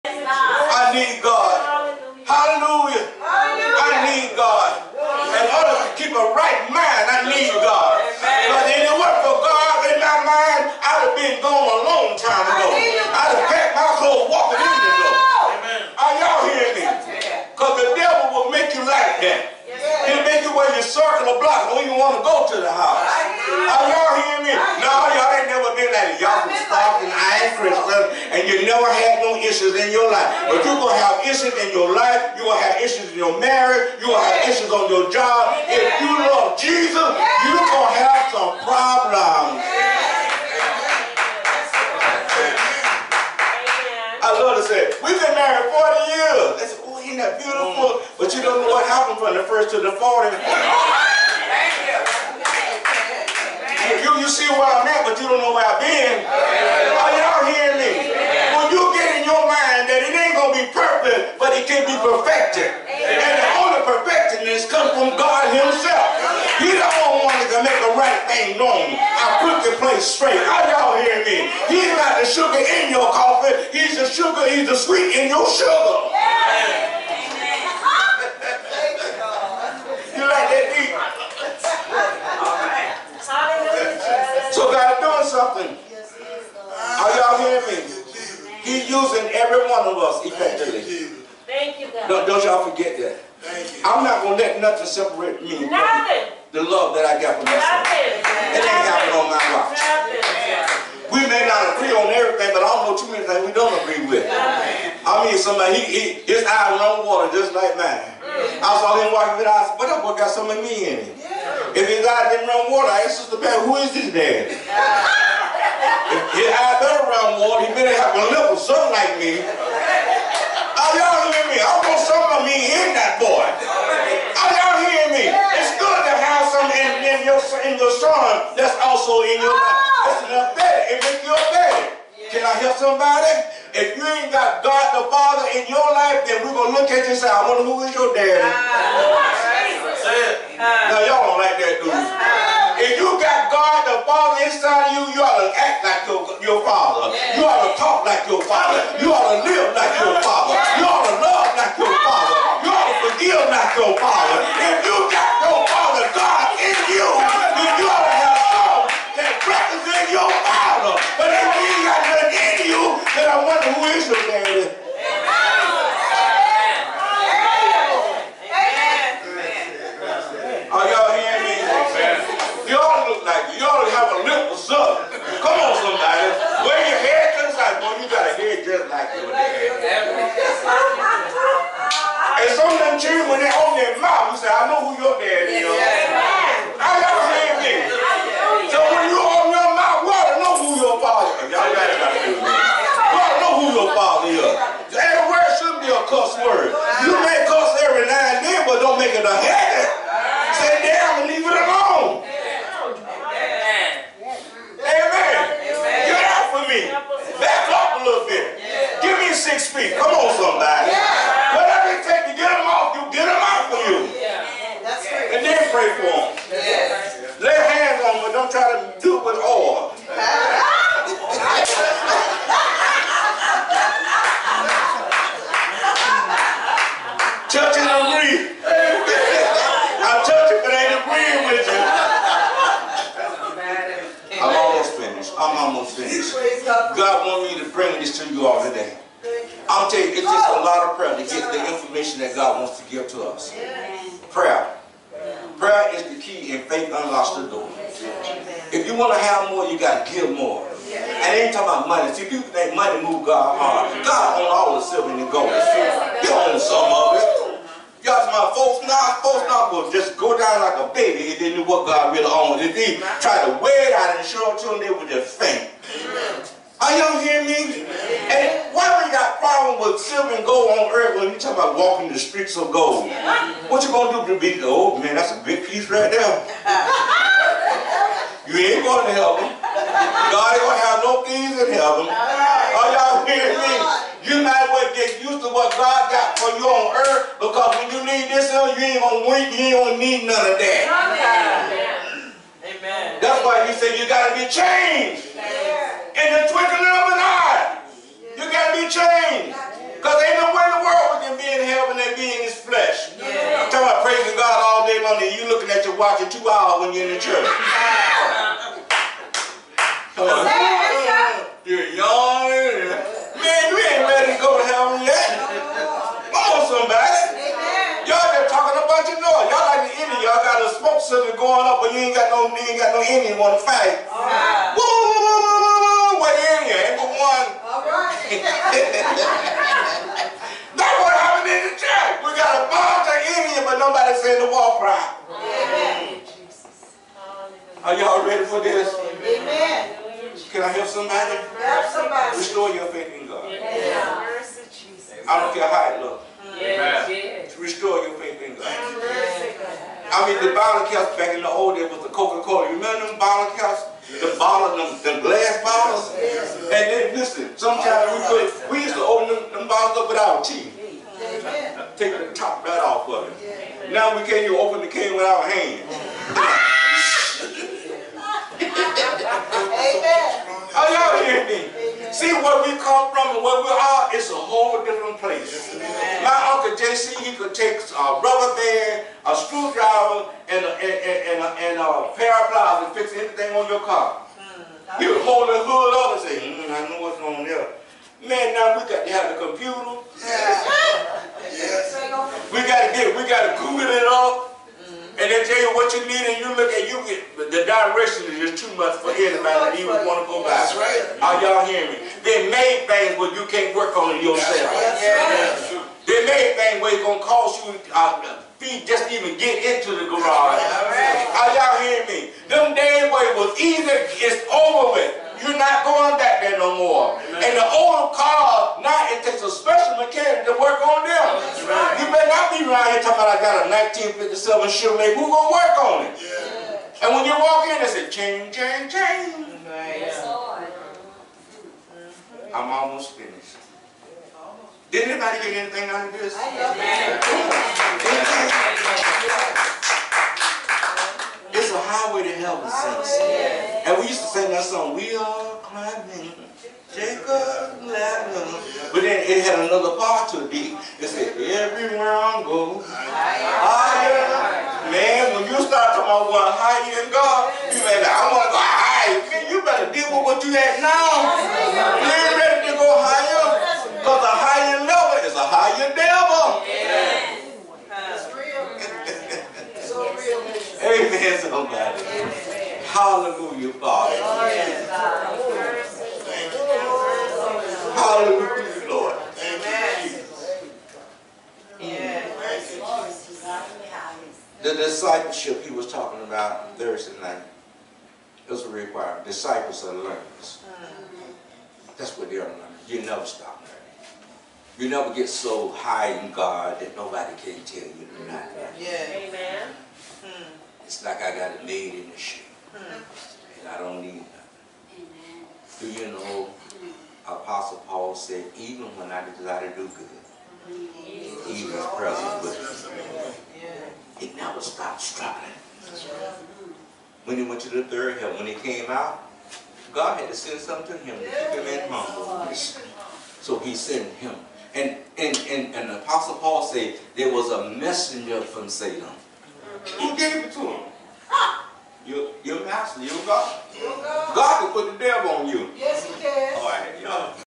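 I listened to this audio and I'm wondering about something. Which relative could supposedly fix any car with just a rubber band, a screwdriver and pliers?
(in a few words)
Uncle JC.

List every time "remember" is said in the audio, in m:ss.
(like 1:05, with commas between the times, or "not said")
5:52.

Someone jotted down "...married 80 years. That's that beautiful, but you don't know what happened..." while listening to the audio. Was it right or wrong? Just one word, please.
wrong.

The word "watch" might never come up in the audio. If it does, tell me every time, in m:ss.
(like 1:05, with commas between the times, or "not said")
1:39, 5:05.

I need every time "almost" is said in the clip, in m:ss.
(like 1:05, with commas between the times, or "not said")
3:55, 7:12.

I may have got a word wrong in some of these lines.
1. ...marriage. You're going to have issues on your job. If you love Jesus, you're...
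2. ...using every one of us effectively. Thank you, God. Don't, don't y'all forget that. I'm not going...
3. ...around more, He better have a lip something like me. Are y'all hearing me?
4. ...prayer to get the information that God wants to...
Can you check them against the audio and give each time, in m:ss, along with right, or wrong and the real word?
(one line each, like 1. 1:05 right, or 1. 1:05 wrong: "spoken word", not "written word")
1. 0:33 right
2. 1:28 right
3. 1:57 right
4. 4:00 right.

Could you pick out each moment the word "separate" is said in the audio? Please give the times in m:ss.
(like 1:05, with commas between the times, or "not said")
1:34.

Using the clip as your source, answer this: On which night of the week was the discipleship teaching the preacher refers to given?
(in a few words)
Thursday.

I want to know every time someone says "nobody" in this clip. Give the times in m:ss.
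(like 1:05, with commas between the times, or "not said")
5:33, 8:16.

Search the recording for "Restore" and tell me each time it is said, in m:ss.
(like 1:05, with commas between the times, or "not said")
5:42, 5:47.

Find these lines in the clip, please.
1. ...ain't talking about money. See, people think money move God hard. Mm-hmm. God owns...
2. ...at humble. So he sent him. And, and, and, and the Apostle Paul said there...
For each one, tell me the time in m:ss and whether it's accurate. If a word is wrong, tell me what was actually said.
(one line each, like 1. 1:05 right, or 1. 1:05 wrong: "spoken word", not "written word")
1. 4:11 right
2. 8:41 right.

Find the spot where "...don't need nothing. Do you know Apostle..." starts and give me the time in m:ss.
8:23.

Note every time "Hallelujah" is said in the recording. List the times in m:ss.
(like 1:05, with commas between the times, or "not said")
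7:52, 7:57.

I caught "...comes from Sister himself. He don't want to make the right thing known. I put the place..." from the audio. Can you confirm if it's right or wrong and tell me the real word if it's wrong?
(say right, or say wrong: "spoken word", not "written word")
wrong: "God", not "Sister".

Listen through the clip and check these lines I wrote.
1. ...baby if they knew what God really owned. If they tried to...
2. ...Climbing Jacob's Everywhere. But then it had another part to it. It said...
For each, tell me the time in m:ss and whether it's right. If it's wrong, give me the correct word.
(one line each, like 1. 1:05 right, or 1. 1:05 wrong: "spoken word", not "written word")
1. 4:20 right
2. 7:25 wrong: "Ladder", not "Everywhere".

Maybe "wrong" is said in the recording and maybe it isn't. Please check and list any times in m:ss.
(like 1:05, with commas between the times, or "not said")
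not said.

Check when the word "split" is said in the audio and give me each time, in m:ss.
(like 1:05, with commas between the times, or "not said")
not said.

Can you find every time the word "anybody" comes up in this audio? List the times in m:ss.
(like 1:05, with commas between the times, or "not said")
6:39, 7:15.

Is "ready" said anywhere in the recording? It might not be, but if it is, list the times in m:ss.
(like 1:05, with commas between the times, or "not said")
5:38, 7:42.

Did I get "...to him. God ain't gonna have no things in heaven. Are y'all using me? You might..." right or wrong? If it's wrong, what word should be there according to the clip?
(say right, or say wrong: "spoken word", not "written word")
wrong: "hearing", not "using".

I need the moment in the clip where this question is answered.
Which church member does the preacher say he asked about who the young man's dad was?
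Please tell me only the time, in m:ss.
1:53.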